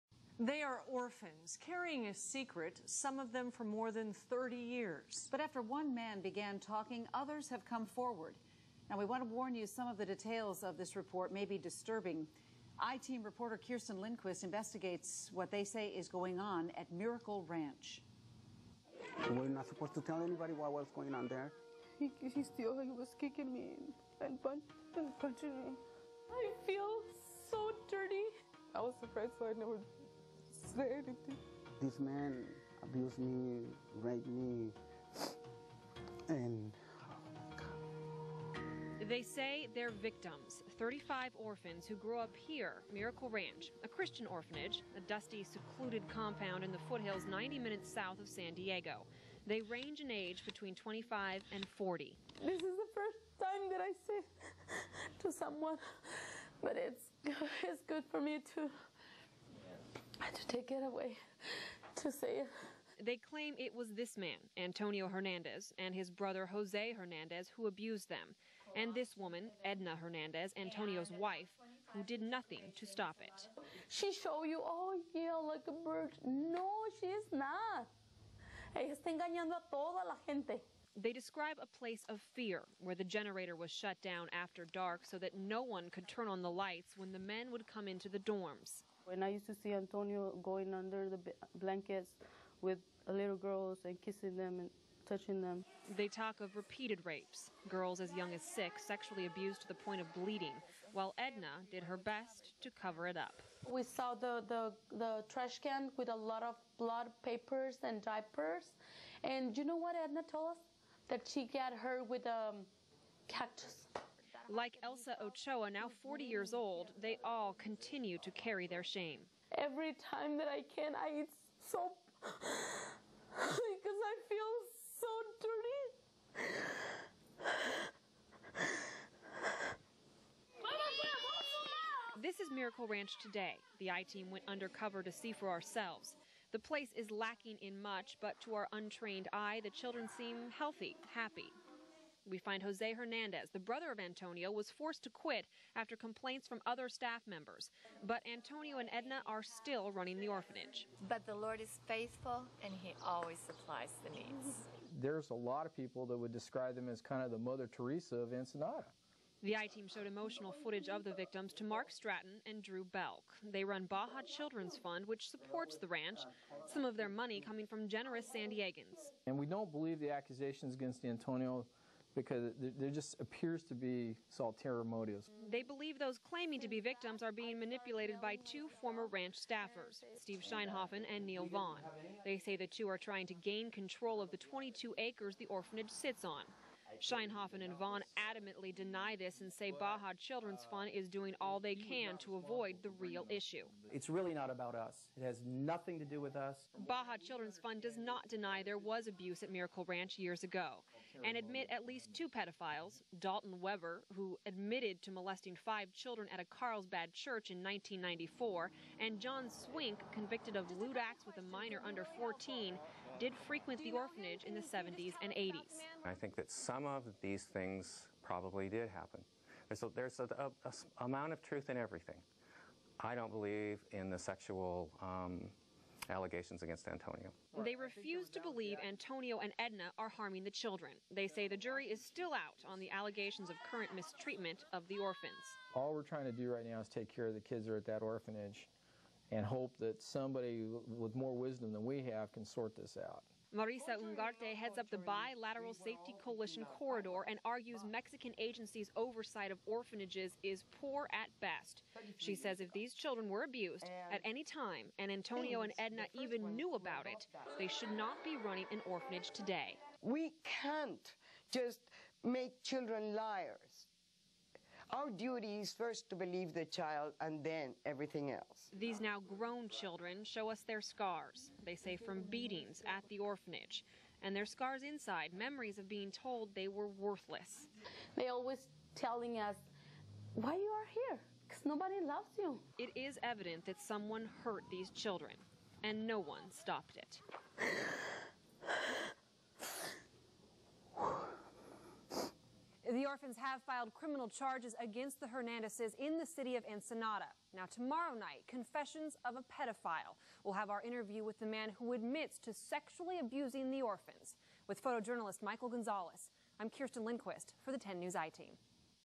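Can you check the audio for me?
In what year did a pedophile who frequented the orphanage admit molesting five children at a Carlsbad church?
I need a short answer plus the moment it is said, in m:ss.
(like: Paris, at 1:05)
1994, at 3:27.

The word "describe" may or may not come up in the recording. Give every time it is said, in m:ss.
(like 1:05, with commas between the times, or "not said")
1:21, 2:36.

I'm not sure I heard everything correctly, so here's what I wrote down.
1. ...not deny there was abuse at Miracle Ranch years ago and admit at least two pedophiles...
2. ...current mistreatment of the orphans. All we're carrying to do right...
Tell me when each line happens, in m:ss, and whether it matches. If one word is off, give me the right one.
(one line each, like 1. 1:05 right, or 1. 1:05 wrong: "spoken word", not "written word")
1. 3:17 right
2. 3:53 wrong: "trying", not "carrying".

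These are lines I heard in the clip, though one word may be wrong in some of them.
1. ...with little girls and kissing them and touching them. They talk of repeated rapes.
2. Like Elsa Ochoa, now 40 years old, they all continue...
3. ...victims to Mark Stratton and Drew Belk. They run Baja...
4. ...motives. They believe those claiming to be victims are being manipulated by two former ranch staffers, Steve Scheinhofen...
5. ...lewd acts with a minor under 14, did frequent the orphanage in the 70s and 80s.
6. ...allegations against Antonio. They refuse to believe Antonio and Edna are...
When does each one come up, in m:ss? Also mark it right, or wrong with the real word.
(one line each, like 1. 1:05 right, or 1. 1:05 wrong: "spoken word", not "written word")
1. 1:32 right
2. 1:54 right
3. 2:41 right
4. 2:54 right
5. 3:30 right
6. 3:46 right.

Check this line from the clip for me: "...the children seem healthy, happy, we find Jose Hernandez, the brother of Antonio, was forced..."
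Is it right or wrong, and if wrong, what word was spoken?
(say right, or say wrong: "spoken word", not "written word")
right.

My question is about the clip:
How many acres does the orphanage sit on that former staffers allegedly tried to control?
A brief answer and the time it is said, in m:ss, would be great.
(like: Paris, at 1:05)
22, at 3:04.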